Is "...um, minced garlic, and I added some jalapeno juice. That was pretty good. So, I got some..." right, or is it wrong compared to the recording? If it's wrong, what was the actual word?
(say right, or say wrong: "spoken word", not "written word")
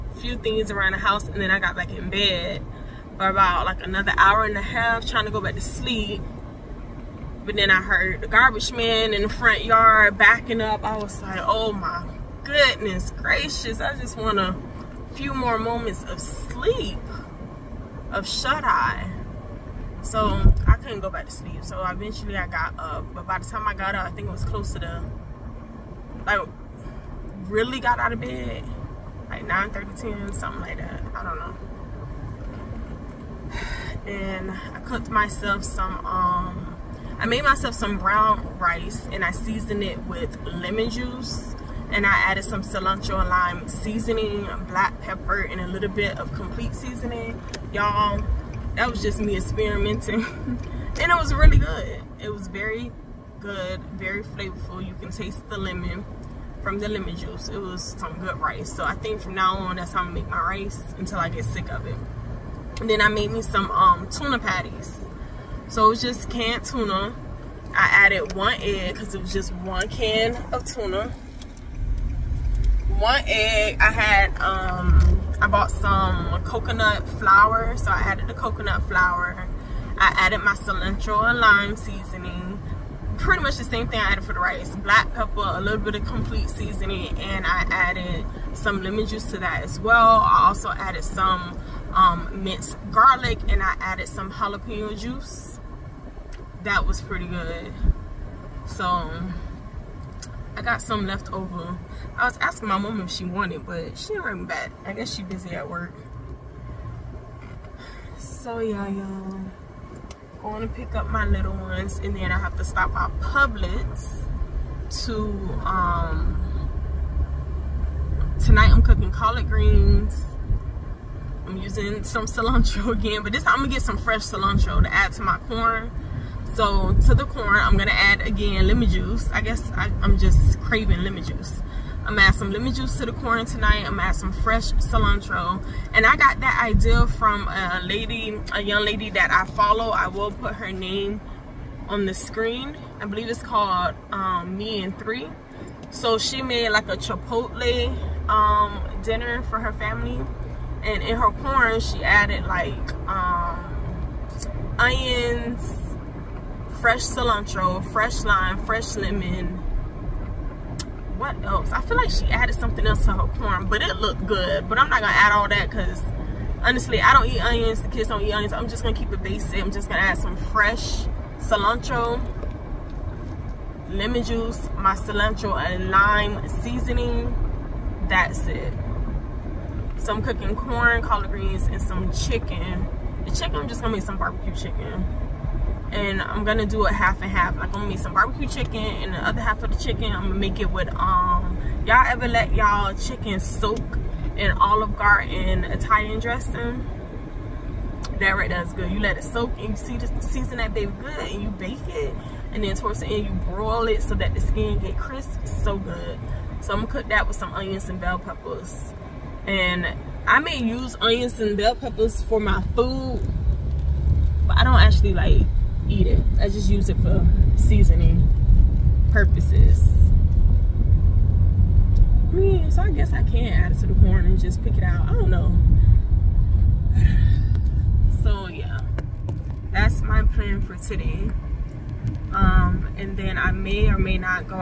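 right.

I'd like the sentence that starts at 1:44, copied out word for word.
I guess she busy at work.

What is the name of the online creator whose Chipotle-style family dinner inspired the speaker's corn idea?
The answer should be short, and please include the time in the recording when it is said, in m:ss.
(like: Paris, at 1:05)
Me and Three, at 2:24.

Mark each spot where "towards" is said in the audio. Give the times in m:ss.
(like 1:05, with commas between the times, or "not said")
3:22.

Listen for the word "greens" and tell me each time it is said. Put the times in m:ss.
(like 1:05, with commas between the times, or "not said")
1:59, 3:01.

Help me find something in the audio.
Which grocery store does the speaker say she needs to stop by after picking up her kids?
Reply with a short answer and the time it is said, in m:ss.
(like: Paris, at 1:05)
Publix, at 1:53.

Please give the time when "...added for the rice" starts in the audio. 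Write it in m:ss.
1:24.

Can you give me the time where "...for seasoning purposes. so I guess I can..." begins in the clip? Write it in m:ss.
3:36.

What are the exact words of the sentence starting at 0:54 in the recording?
You can taste the lemon from the lemon juice.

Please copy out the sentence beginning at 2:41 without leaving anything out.
I feel like she added something else to her corn, but it looked good.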